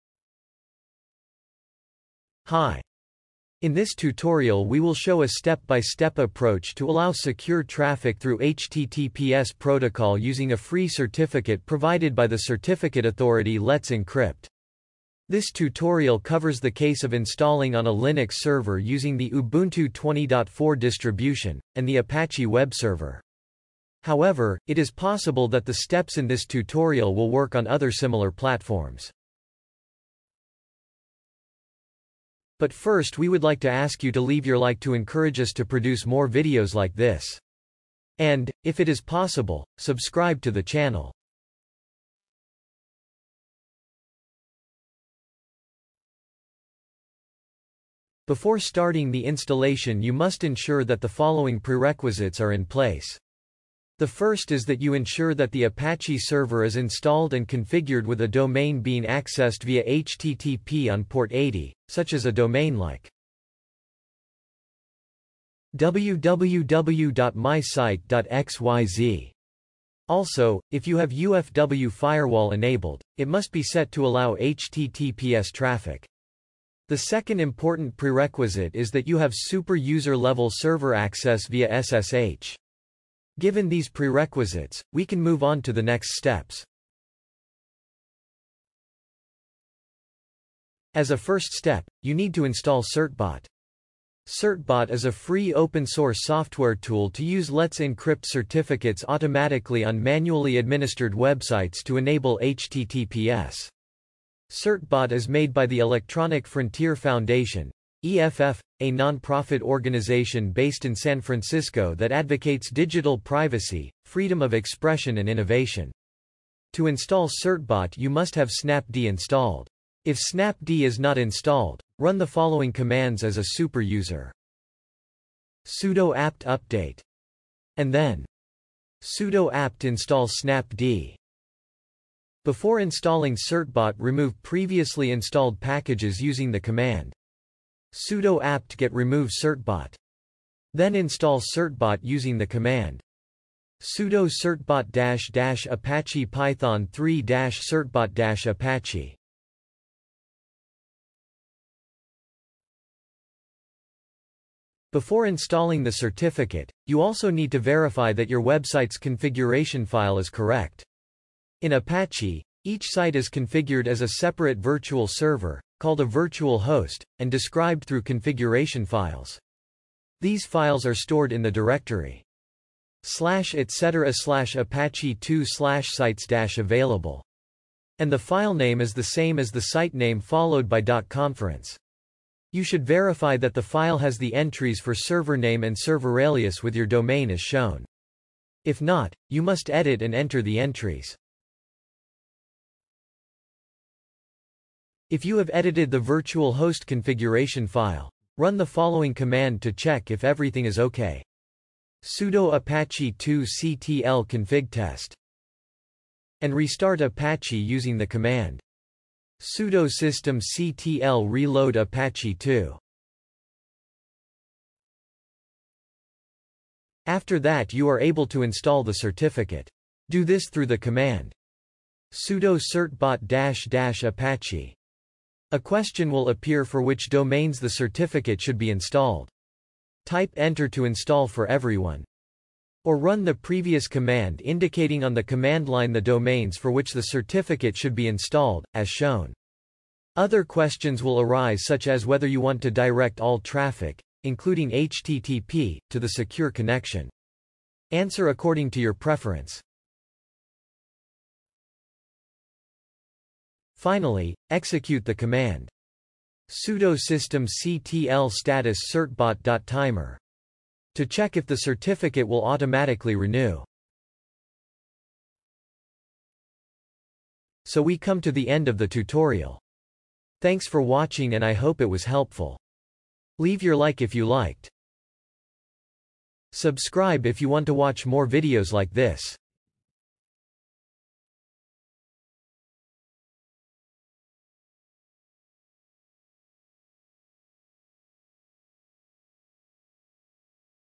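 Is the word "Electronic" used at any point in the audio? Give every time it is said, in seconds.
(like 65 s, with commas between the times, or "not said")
105 s.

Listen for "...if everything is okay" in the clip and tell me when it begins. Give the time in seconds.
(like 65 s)
200 s.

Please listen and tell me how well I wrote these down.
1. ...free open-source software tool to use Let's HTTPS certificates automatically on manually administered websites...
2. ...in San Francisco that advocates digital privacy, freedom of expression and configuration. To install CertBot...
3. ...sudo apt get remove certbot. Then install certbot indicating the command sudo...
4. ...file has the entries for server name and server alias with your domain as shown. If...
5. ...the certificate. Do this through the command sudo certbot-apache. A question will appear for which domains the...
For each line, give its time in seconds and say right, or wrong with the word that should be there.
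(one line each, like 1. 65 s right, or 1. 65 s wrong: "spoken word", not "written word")
1. 95 s wrong: "Encrypt", not "HTTPS"
2. 110 s wrong: "innovation", not "configuration"
3. 137 s wrong: "using", not "indicating"
4. 183 s right
5. 218 s right.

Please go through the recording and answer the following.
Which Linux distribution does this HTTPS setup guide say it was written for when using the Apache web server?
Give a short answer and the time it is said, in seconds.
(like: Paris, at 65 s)
Ubuntu 20.4, at 19 s.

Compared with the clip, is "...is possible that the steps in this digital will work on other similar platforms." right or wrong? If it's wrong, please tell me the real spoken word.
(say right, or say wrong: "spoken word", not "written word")
wrong: "tutorial", not "digital".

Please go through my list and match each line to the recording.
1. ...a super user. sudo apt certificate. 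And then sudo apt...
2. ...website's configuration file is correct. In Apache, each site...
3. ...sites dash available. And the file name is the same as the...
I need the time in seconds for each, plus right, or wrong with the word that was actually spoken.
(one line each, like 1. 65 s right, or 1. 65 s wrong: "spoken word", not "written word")
1. 123 s wrong: "update", not "certificate"
2. 158 s right
3. 175 s right.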